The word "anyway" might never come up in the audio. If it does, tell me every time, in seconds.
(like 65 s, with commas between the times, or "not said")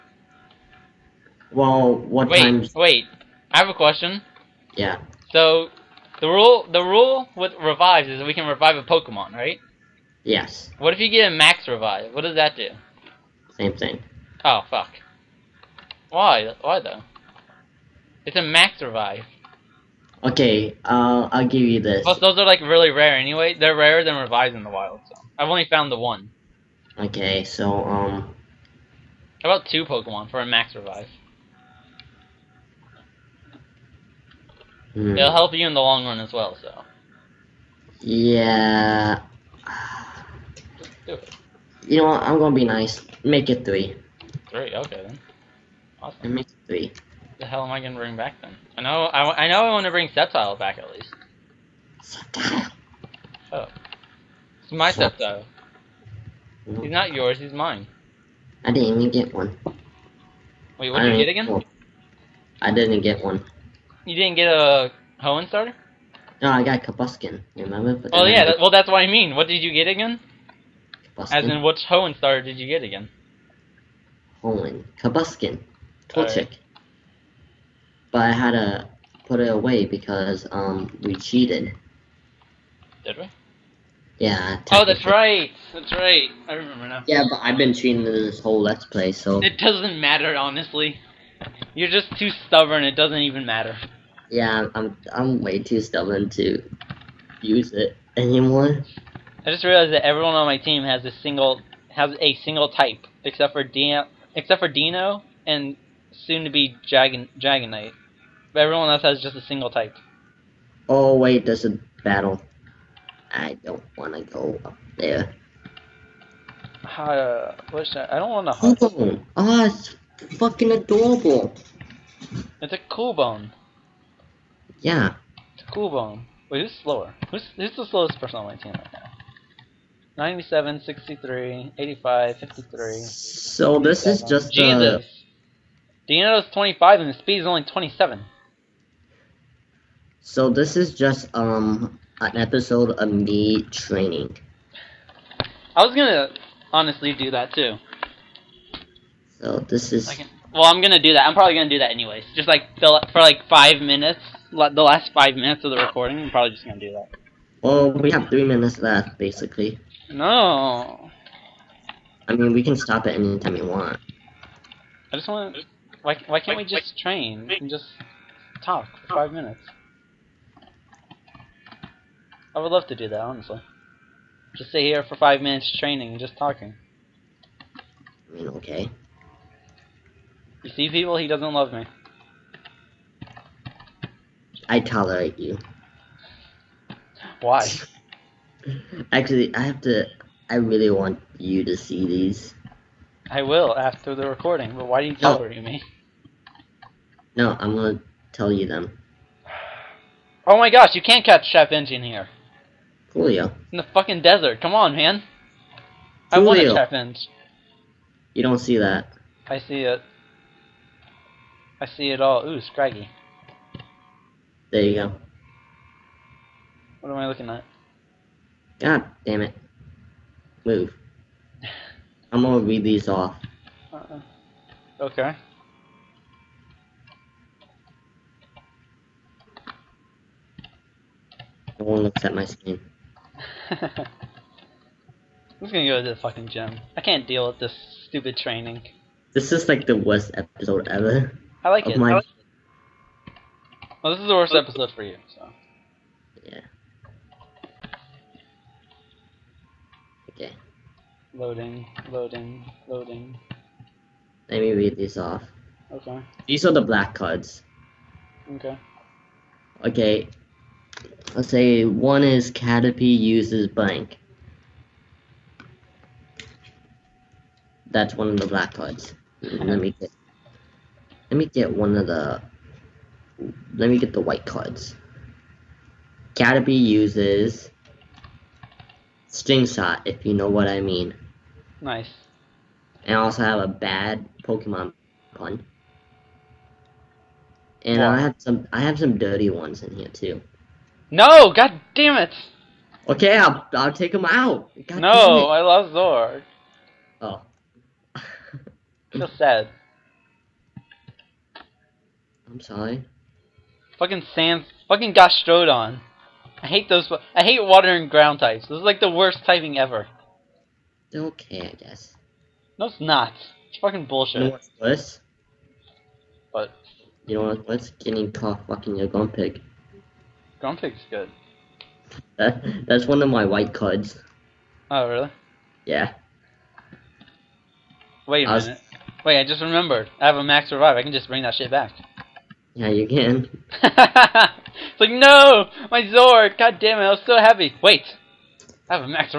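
23 s, 151 s.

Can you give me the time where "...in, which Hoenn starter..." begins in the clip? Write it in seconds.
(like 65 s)
71 s.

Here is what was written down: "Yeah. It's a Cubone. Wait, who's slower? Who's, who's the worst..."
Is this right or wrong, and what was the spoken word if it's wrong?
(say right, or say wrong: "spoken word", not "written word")
wrong: "slowest", not "worst".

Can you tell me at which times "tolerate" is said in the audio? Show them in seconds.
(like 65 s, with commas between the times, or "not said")
184 s, 195 s.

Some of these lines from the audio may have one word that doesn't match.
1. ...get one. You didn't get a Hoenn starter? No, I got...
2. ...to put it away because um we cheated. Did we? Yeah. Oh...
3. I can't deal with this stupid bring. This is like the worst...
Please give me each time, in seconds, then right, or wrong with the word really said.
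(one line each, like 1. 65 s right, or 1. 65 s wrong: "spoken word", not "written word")
1. 63 s right
2. 78 s right
3. 236 s wrong: "training", not "bring".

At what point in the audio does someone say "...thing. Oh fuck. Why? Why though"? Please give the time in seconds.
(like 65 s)
13 s.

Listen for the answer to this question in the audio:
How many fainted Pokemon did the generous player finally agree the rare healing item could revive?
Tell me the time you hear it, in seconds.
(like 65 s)
43 s.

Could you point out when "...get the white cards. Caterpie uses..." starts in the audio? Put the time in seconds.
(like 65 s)
273 s.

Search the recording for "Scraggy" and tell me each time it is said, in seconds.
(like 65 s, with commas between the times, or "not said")
212 s.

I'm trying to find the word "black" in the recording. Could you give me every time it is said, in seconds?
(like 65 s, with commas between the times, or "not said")
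256 s, 268 s.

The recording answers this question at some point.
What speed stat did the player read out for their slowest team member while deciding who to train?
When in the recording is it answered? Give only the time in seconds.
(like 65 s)
137 s.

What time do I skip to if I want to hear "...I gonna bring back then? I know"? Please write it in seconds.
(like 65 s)
47 s.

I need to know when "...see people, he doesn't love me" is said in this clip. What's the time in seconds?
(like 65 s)
180 s.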